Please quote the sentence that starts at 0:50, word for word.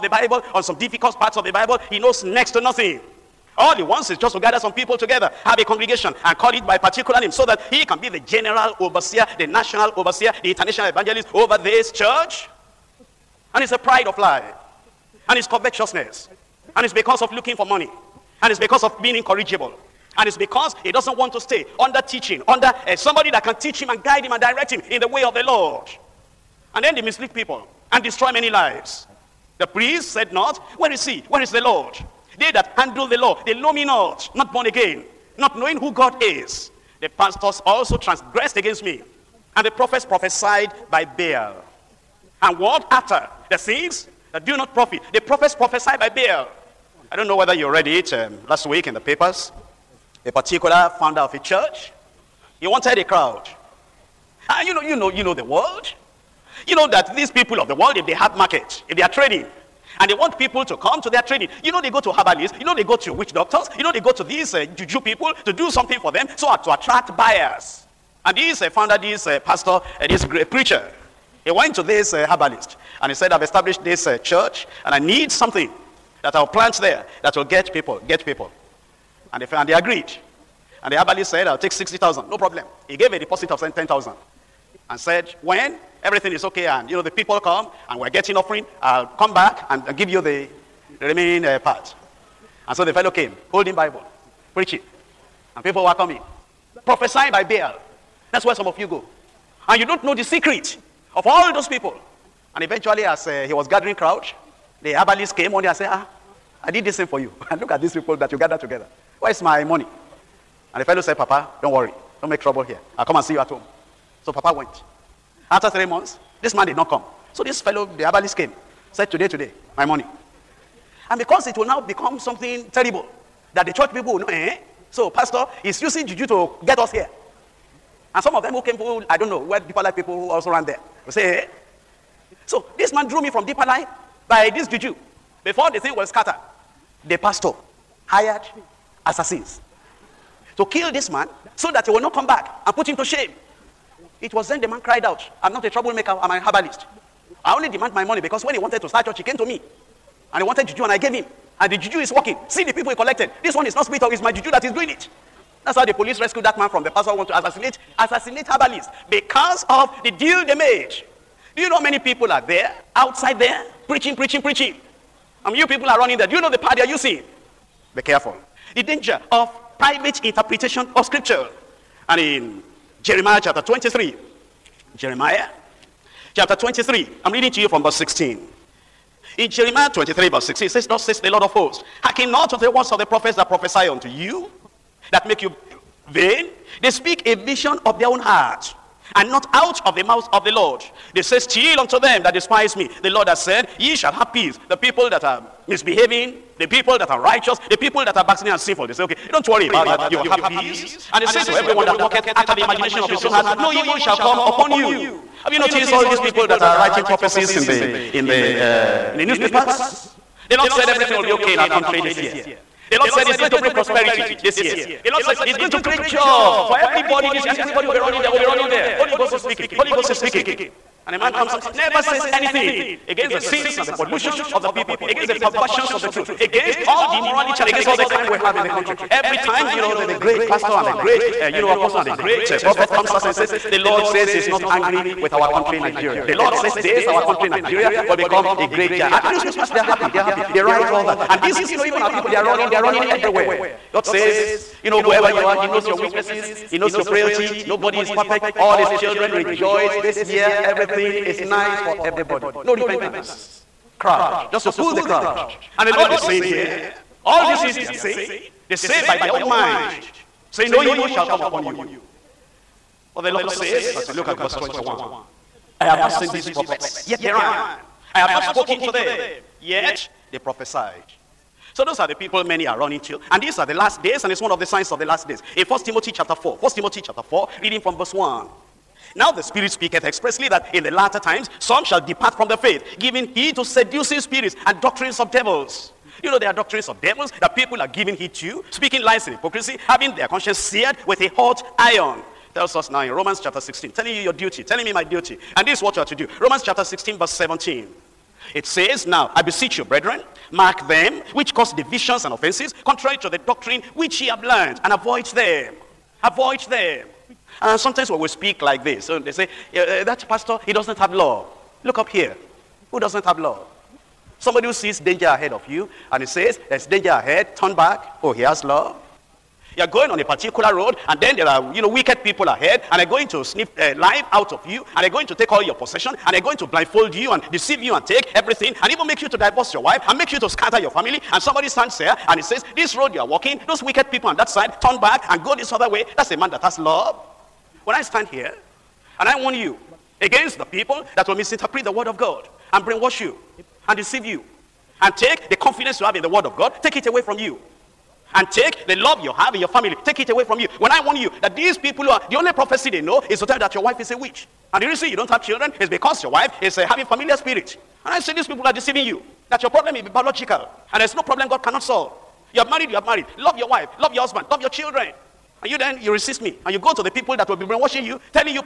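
A particular founder of a church, he wanted a crowd.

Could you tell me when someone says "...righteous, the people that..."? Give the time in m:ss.
3:17.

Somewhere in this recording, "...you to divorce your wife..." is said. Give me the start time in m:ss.
5:29.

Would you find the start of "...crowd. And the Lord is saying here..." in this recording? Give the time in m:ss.
4:15.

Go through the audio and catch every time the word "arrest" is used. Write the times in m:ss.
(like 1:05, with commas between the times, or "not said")
not said.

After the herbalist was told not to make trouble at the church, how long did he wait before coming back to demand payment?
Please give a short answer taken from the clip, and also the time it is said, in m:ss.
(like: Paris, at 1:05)
three months, at 1:55.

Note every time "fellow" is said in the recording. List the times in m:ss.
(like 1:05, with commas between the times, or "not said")
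1:32, 1:50, 1:57.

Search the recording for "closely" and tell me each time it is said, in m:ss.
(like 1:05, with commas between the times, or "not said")
not said.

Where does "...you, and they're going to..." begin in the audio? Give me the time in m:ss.
5:24.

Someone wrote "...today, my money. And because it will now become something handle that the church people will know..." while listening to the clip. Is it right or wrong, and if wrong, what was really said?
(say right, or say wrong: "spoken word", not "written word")
wrong: "terrible", not "handle".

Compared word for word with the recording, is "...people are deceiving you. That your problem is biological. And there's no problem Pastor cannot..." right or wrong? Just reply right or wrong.
wrong.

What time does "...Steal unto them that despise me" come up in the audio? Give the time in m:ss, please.
3:11.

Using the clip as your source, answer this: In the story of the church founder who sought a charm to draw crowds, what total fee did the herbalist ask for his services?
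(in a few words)
60,000.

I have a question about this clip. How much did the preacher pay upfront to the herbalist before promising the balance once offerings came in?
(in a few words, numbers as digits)
10,000.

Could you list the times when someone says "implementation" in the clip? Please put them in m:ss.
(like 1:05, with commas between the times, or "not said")
not said.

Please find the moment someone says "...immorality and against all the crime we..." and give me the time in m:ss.
3:47.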